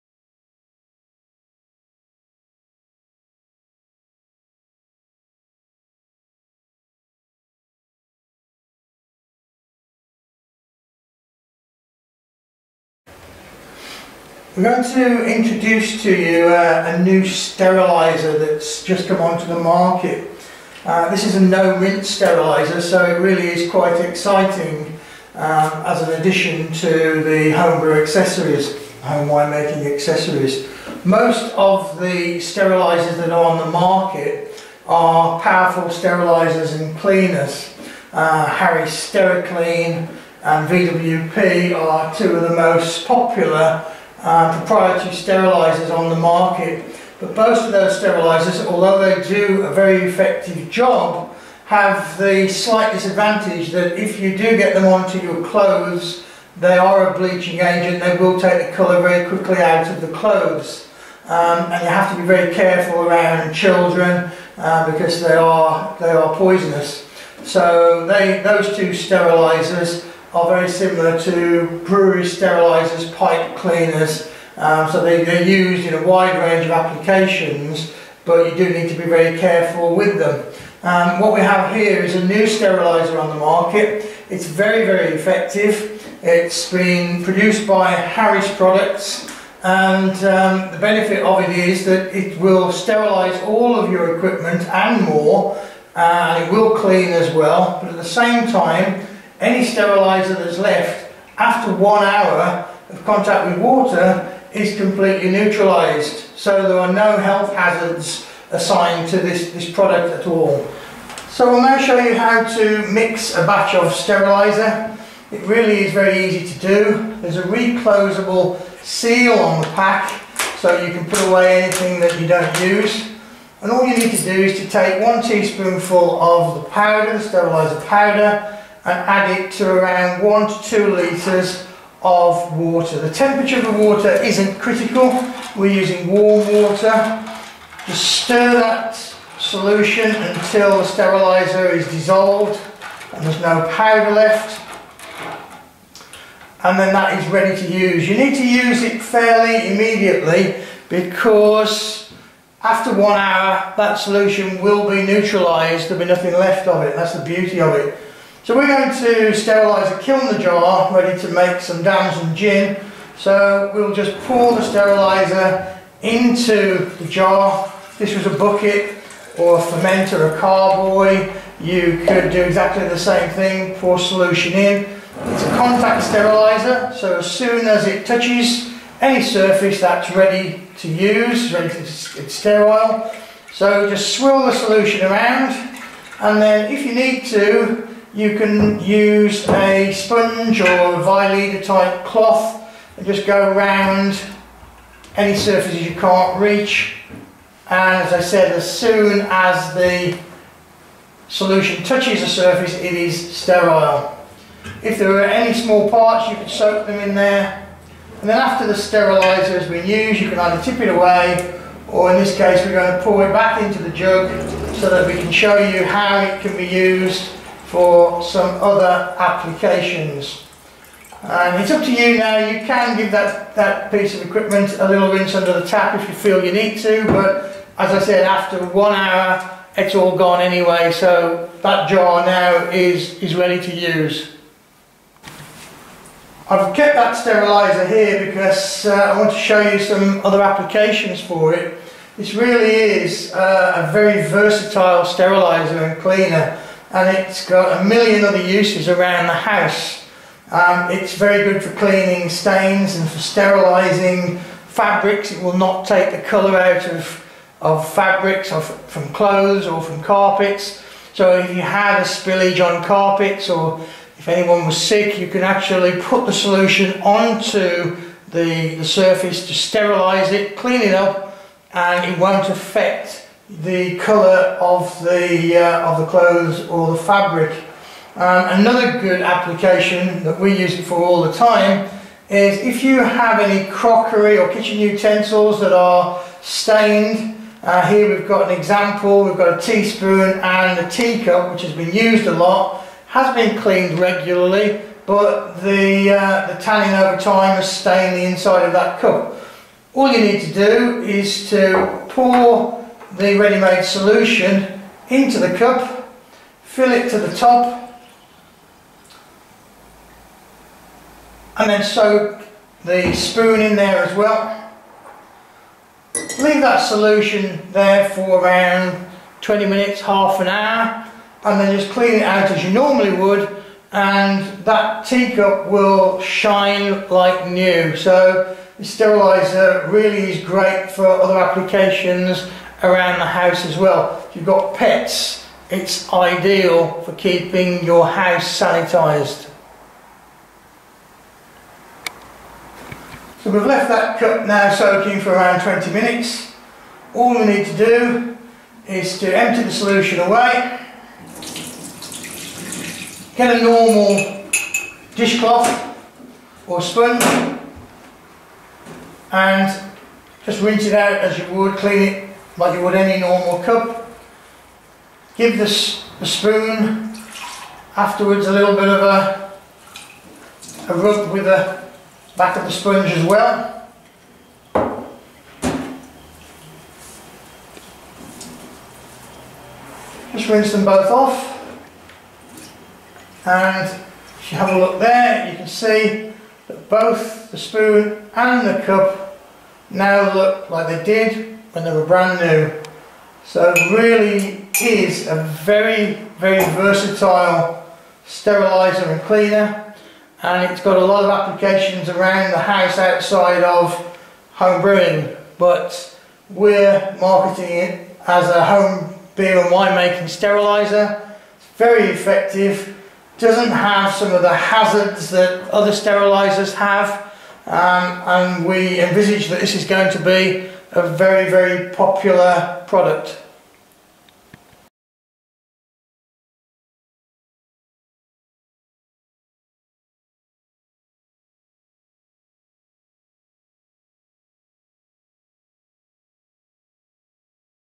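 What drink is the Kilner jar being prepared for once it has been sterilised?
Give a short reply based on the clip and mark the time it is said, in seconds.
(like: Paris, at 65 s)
Damson gin, at 161 s.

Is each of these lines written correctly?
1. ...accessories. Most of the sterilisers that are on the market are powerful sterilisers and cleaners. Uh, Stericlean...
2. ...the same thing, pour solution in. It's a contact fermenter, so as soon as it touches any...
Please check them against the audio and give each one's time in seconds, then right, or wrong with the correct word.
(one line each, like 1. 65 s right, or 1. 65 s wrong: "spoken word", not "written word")
1. 29 s wrong: "Harry", not "Stericlean"
2. 172 s wrong: "steriliser", not "fermenter".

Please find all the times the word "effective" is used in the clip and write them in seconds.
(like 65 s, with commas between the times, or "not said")
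50 s, 85 s, 412 s.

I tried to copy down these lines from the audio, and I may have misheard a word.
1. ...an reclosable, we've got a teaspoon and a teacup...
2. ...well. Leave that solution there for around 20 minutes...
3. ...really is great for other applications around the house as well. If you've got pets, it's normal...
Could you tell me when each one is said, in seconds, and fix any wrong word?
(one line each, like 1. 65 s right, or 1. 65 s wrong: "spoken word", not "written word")
1. 288 s wrong: "example", not "reclosable"
2. 314 s right
3. 329 s wrong: "ideal", not "normal".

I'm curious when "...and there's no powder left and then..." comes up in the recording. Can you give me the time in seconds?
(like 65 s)
143 s.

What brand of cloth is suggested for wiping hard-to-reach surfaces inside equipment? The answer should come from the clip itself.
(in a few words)
Vileda.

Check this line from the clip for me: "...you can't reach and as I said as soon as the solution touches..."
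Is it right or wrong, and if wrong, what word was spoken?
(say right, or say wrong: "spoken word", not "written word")
right.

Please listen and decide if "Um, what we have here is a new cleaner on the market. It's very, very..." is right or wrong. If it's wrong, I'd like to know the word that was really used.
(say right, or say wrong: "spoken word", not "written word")
wrong: "steriliser", not "cleaner".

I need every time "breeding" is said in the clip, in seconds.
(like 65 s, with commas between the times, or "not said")
not said.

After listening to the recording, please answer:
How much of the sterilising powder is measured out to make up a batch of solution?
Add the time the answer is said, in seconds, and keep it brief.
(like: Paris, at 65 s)
1 teaspoonful, at 125 s.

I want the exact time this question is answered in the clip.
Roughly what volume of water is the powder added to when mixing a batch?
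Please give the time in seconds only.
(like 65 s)
130 s.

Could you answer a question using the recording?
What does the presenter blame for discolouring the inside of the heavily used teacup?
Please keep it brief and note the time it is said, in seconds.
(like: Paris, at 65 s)
Tanning, at 296 s.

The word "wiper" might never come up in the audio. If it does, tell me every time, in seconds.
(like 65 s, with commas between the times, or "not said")
not said.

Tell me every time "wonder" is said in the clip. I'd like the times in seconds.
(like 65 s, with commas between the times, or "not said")
not said.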